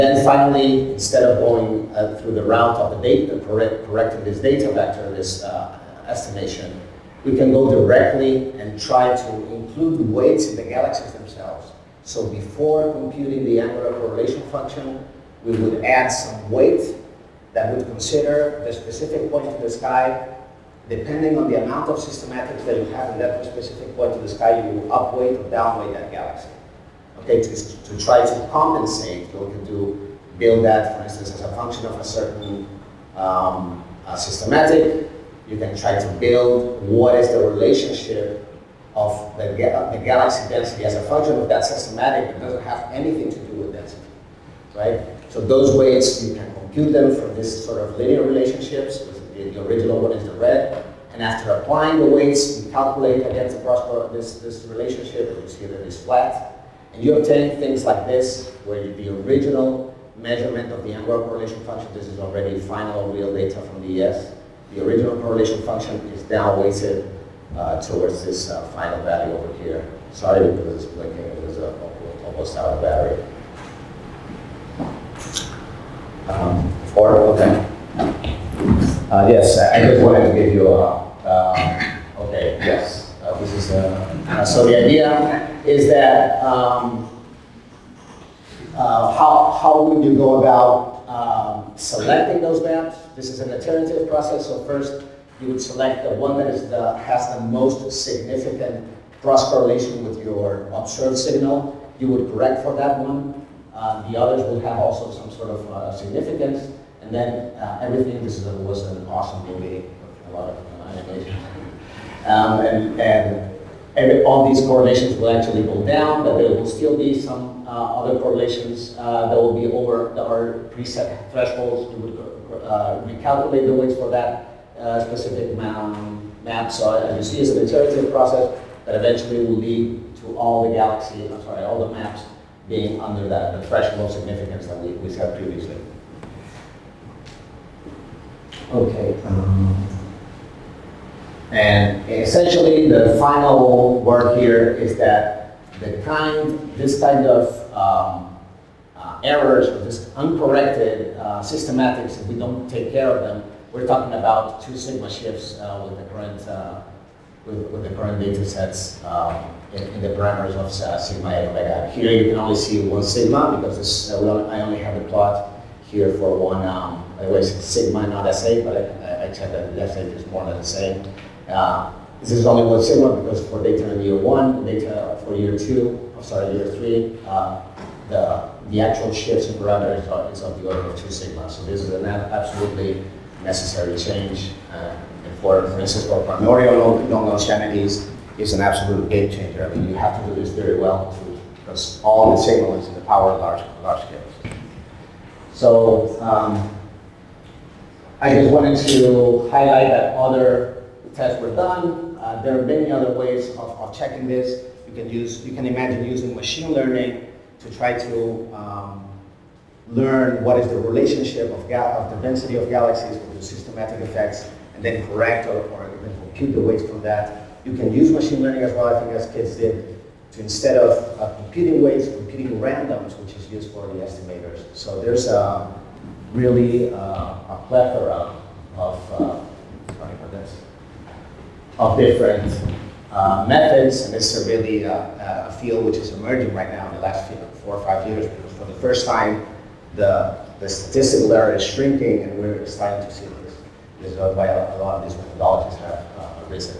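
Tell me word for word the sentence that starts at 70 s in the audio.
Sorry because it's blinking, it was uh, almost out of battery.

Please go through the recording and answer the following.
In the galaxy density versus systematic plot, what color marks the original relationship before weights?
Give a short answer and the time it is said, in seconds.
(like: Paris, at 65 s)
Red, at 50 s.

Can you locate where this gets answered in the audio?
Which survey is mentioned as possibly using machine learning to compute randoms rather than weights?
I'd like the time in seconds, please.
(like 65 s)
219 s.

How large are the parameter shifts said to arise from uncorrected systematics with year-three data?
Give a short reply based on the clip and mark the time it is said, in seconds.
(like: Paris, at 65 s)
2 sigma, at 180 s.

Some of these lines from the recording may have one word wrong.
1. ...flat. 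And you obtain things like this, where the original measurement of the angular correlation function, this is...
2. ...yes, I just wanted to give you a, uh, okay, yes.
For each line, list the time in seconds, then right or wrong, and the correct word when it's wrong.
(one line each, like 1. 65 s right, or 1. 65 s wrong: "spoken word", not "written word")
1. 56 s right
2. 79 s right.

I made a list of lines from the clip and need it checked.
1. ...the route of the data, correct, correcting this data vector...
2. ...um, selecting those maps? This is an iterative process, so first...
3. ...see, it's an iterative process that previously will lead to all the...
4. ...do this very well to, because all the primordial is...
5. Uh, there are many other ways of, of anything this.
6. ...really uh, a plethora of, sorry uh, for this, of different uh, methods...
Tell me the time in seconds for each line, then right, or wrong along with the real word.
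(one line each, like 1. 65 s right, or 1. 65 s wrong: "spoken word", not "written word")
1. 2 s right
2. 91 s right
3. 127 s wrong: "eventually", not "previously"
4. 190 s wrong: "signal", not "primordial"
5. 202 s wrong: "checking", not "anything"
6. 226 s right.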